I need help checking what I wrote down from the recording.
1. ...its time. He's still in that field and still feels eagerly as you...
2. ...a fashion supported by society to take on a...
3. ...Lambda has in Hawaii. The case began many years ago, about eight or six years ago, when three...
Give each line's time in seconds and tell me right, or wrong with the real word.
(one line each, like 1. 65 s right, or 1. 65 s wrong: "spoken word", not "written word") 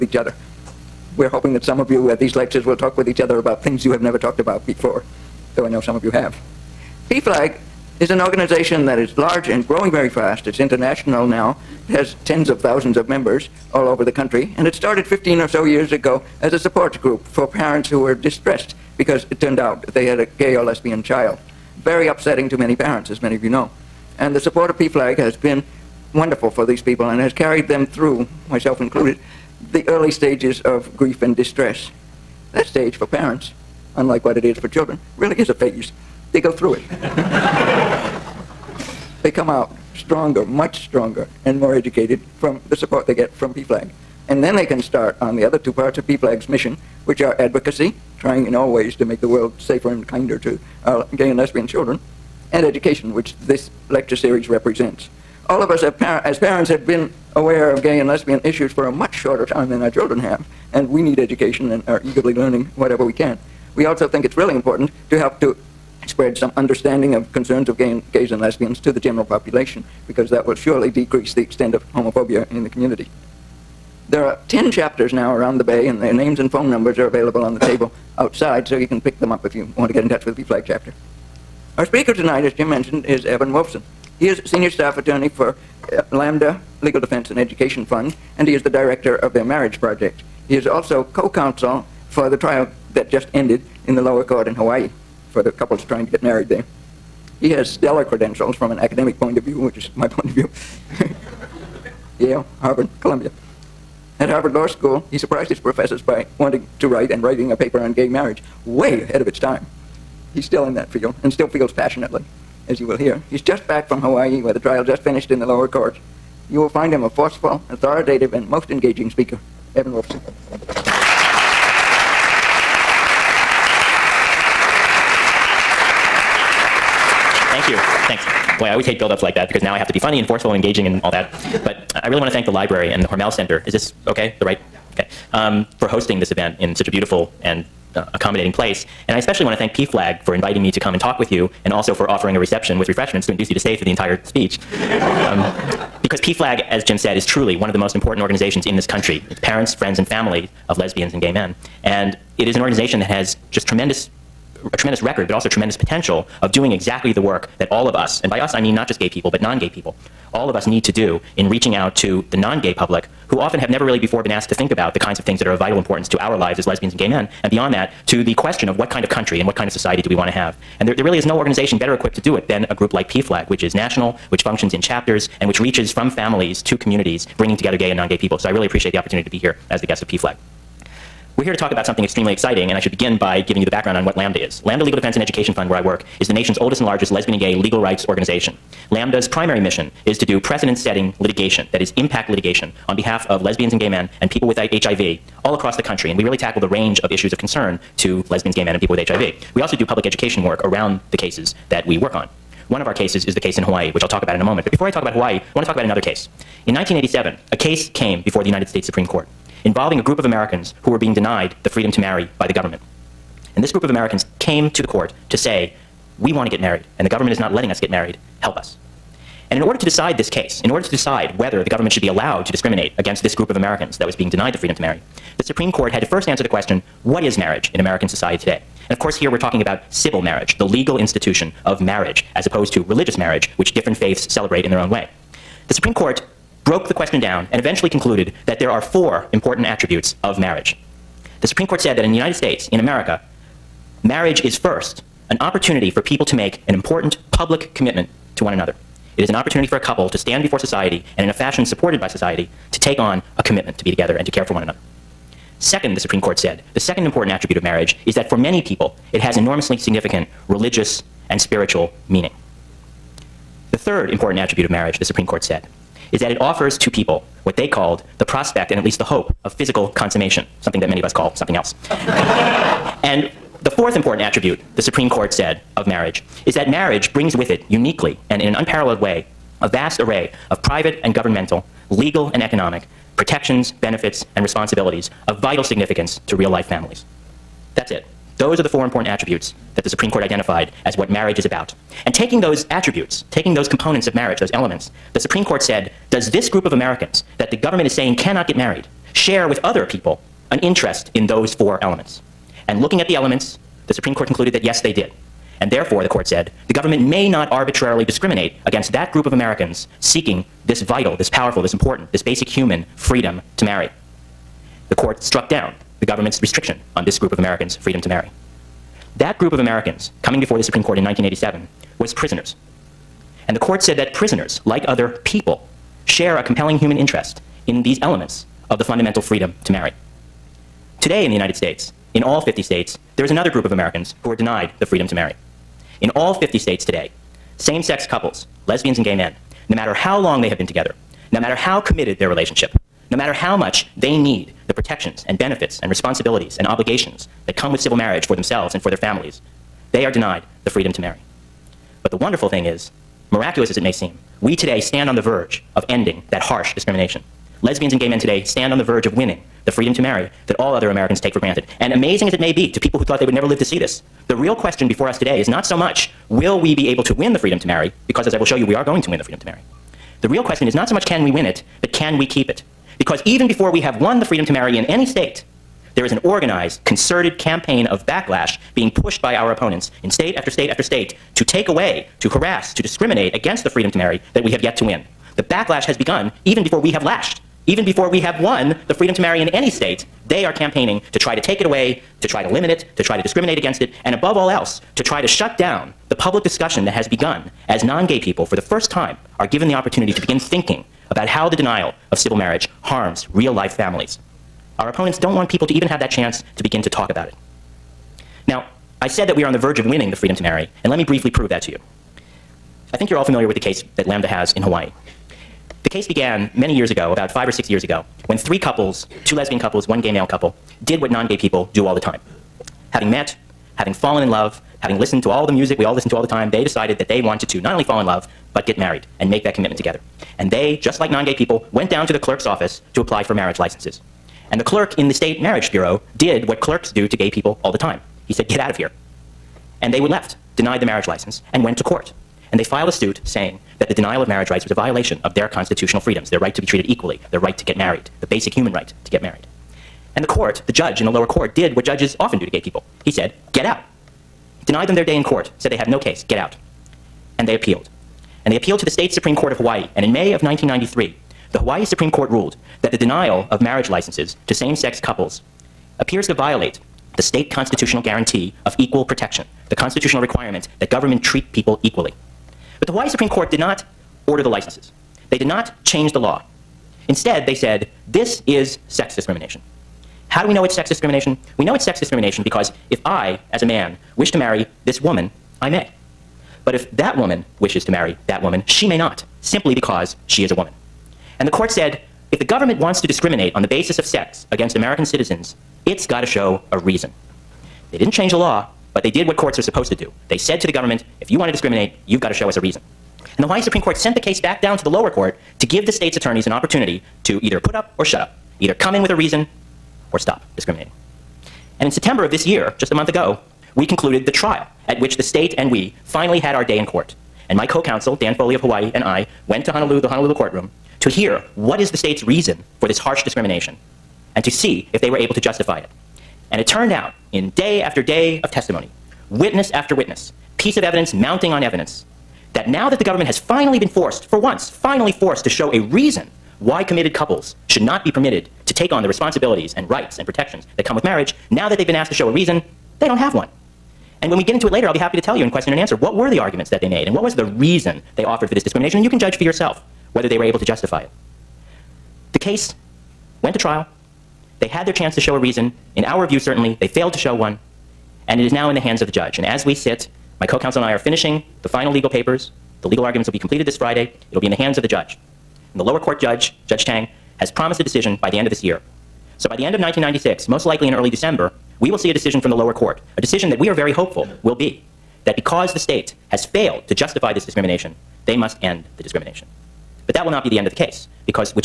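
1. 109 s wrong: "passionately", not "eagerly"
2. 251 s right
3. 414 s wrong: "five", not "eight".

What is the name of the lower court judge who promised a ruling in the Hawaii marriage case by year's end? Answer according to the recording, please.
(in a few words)
Judge Chang.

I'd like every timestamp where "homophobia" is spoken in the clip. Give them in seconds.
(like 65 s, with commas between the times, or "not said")
71 s.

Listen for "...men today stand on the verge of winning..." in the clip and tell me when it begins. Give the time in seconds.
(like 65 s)
358 s.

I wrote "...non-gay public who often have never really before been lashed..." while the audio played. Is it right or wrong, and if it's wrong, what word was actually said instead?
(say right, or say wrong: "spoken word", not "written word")
wrong: "asked", not "lashed".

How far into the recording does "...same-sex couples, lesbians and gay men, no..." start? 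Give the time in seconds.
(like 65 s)
337 s.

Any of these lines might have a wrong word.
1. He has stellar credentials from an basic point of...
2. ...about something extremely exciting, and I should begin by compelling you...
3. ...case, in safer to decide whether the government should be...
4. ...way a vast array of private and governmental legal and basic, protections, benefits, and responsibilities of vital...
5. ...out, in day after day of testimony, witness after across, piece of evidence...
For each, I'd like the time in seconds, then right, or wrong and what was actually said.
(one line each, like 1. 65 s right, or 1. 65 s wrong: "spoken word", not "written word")
1. 97 s wrong: "academic", not "basic"
2. 181 s wrong: "giving", not "compelling"
3. 220 s wrong: "order", not "safer"
4. 279 s wrong: "economic", not "basic"
5. 526 s wrong: "witness", not "across".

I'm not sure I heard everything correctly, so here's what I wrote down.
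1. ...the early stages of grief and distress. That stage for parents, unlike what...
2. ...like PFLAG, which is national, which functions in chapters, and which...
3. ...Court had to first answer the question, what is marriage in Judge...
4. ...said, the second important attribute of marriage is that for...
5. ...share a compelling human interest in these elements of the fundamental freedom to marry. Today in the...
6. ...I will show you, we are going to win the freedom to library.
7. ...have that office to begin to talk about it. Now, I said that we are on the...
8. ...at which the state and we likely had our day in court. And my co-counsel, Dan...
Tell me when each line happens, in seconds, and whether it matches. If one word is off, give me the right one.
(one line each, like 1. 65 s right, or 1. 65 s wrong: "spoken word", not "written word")
1. 29 s right
2. 172 s right
3. 225 s wrong: "American", not "Judge"
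4. 256 s right
5. 326 s right
6. 368 s wrong: "marry", not "library"
7. 405 s wrong: "chance", not "office"
8. 514 s wrong: "finally", not "likely".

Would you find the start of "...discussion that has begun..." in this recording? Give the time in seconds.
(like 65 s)
396 s.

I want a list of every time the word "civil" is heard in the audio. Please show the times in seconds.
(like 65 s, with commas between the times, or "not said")
229 s, 347 s, 402 s.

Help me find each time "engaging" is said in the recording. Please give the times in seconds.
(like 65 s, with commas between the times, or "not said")
118 s, 130 s.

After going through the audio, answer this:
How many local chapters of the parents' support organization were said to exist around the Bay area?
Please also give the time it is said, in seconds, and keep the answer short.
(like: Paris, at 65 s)
10, at 74 s.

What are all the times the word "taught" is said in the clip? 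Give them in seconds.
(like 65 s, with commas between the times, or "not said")
not said.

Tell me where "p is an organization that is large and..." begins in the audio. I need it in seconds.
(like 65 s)
7 s.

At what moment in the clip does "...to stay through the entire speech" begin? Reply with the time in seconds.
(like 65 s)
143 s.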